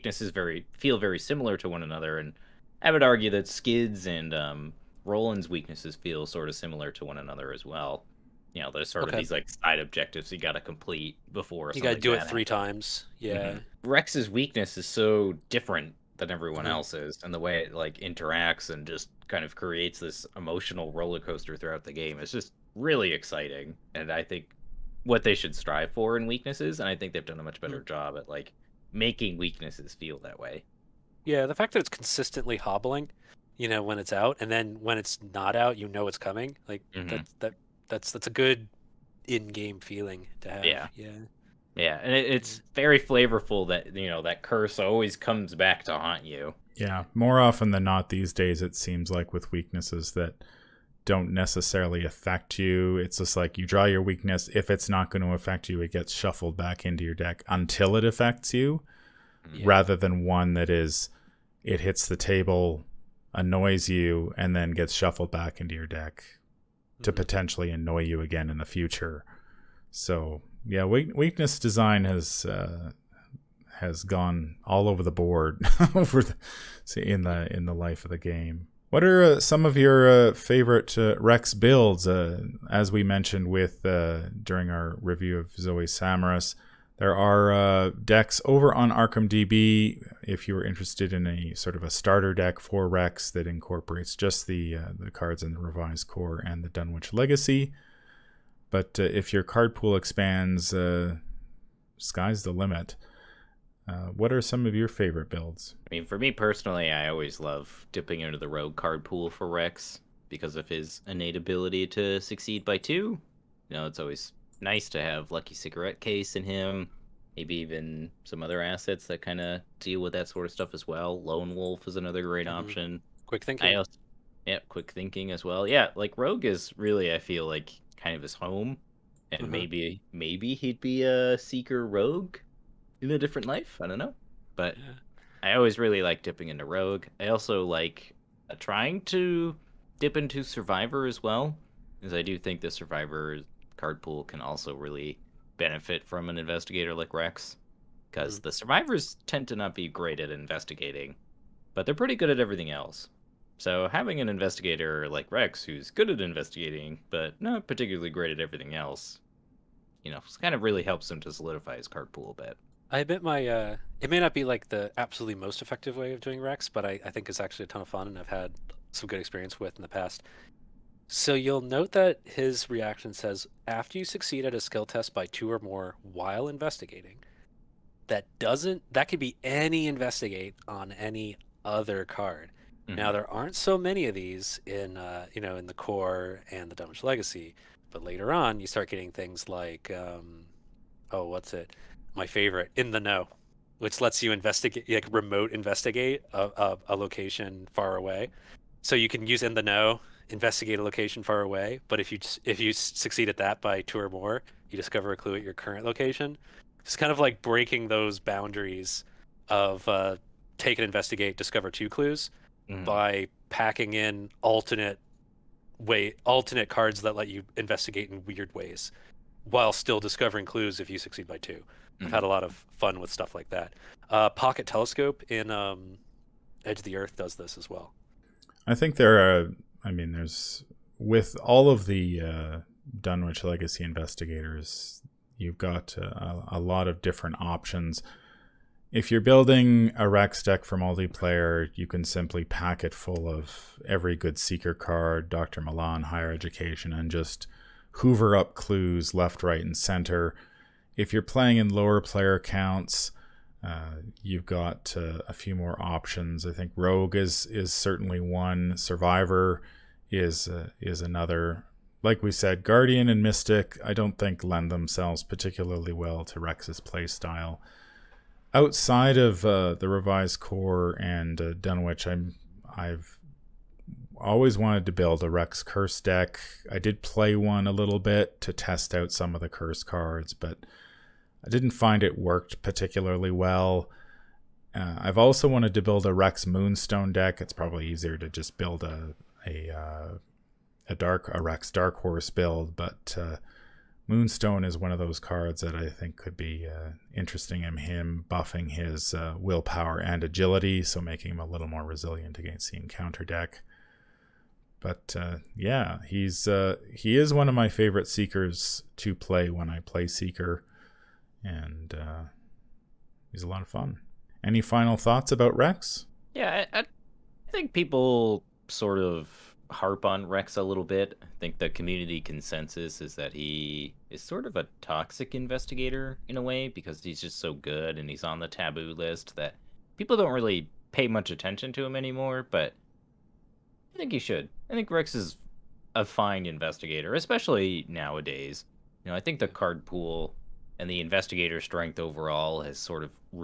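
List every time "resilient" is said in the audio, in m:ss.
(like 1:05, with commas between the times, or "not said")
5:01.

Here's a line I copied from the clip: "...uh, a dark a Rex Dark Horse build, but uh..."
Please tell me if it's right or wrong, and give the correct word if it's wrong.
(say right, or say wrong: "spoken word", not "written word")
right.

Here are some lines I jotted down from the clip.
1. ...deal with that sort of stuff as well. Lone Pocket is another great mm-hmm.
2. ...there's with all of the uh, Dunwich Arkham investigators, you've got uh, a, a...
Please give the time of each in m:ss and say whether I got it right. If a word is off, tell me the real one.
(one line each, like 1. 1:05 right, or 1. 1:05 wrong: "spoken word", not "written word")
1. 1:59 wrong: "Wolf", not "Pocket"
2. 3:50 wrong: "Legacy", not "Arkham".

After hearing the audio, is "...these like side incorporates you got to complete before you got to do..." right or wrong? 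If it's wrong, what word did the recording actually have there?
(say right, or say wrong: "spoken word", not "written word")
wrong: "objectives", not "incorporates".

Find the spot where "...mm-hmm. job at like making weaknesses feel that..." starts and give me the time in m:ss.
0:27.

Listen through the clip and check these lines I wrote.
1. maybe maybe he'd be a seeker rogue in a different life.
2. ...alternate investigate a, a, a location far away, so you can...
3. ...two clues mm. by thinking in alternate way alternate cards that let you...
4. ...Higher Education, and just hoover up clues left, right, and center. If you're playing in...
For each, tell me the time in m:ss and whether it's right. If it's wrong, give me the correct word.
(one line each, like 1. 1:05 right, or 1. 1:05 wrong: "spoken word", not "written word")
1. 2:09 right
2. 3:15 wrong: "remote", not "alternate"
3. 3:31 wrong: "packing", not "thinking"
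4. 4:06 right.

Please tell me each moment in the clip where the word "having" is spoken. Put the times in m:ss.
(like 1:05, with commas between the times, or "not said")
2:33.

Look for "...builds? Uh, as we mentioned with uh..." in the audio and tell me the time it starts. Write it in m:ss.
1:21.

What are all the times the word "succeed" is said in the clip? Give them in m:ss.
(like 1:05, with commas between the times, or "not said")
1:52, 2:54, 3:22, 3:40.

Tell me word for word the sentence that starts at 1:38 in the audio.
But uh, if your card pool expands, uh, sky's the limit.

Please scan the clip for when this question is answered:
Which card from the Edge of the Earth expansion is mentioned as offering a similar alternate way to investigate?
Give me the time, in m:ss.
3:44.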